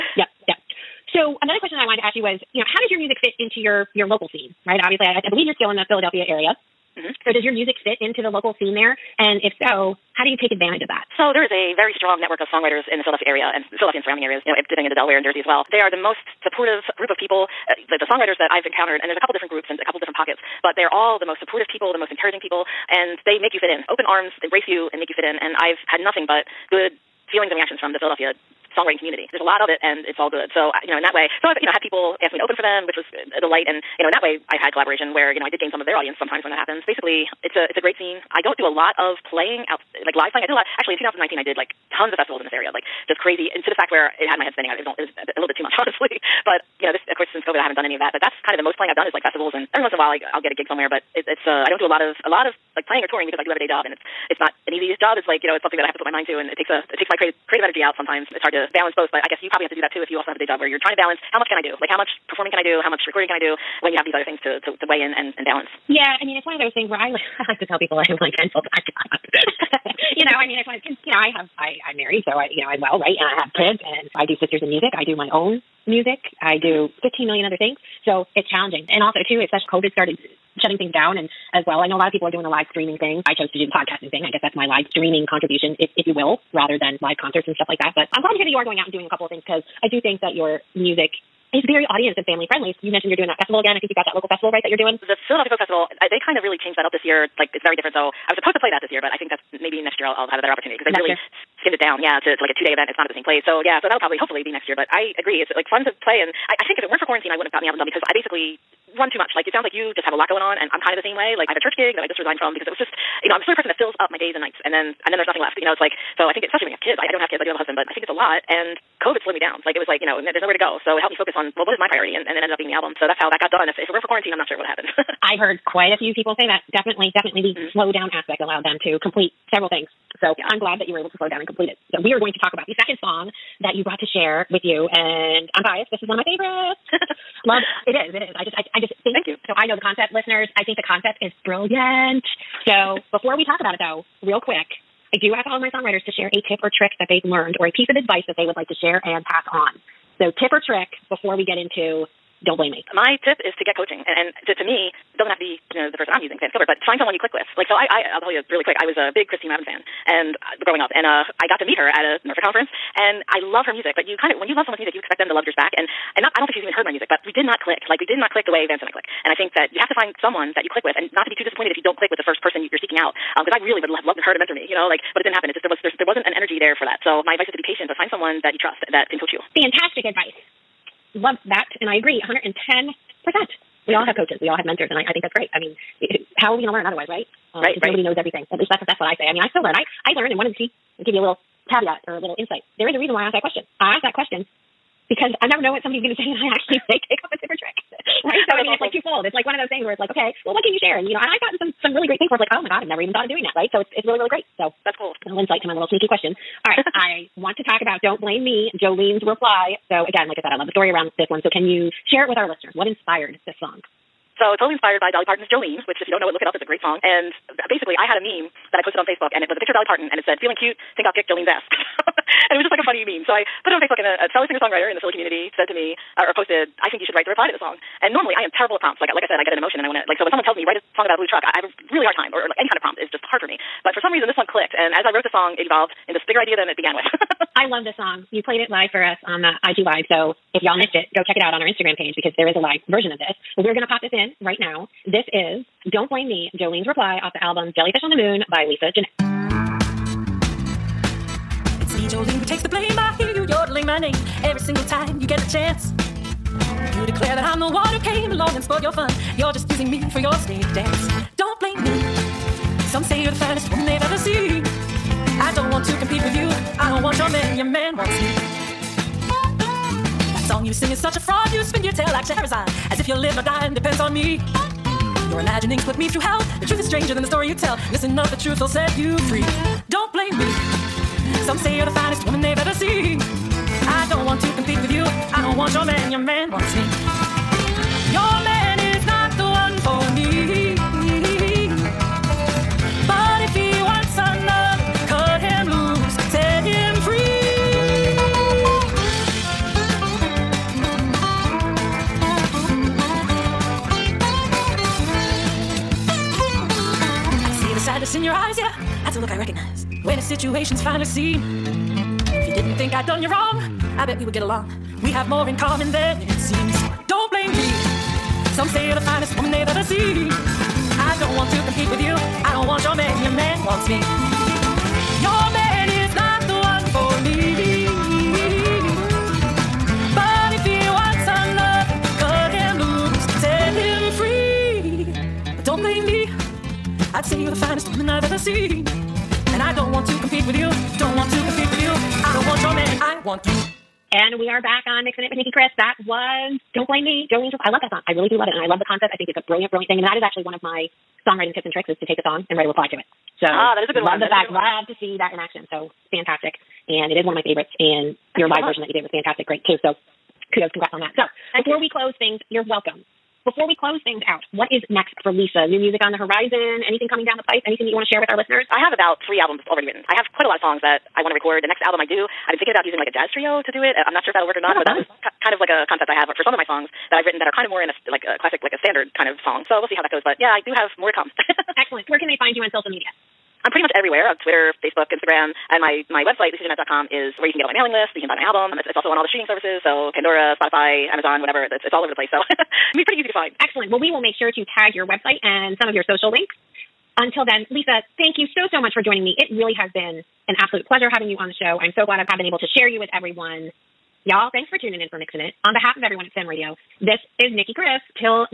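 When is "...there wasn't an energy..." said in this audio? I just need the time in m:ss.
2:56.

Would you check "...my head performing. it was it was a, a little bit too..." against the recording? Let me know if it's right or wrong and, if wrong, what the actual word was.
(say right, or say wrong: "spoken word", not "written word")
wrong: "spinning", not "performing".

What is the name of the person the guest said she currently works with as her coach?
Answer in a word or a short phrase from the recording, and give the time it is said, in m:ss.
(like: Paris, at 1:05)
Vance Gilbert, at 2:36.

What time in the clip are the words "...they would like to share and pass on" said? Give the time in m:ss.
2:28.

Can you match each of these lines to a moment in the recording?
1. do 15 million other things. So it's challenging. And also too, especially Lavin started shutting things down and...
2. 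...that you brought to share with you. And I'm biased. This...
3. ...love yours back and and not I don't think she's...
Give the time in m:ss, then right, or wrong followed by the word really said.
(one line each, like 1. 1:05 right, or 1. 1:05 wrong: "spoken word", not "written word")
1. 1:16 wrong: "COVID", not "Lavin"
2. 2:13 right
3. 2:45 right.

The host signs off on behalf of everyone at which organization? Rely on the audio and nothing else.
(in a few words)
SIM Radio.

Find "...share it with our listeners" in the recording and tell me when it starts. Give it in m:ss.
3:32.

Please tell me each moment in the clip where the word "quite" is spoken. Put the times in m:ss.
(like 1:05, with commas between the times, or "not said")
2:05, 6:10.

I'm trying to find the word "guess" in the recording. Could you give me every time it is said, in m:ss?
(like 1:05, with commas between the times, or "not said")
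0:59, 1:24.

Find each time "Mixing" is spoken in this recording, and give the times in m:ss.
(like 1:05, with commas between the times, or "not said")
5:45, 6:45.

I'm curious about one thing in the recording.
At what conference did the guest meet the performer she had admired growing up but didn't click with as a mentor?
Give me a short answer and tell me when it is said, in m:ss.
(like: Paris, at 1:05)
NERFA, at 2:42.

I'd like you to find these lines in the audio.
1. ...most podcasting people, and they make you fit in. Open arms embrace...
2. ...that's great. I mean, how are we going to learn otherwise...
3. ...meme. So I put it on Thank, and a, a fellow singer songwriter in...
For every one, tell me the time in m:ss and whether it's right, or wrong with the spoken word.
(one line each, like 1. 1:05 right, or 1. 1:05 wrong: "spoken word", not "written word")
1. 0:21 wrong: "encouraging", not "podcasting"
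2. 3:05 right
3. 3:43 wrong: "Facebook", not "Thank".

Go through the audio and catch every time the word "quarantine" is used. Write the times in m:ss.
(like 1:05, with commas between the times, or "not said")
1:47, 2:04.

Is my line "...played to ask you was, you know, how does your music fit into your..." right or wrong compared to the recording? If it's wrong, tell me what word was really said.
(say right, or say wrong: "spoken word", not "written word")
wrong: "wanted", not "played".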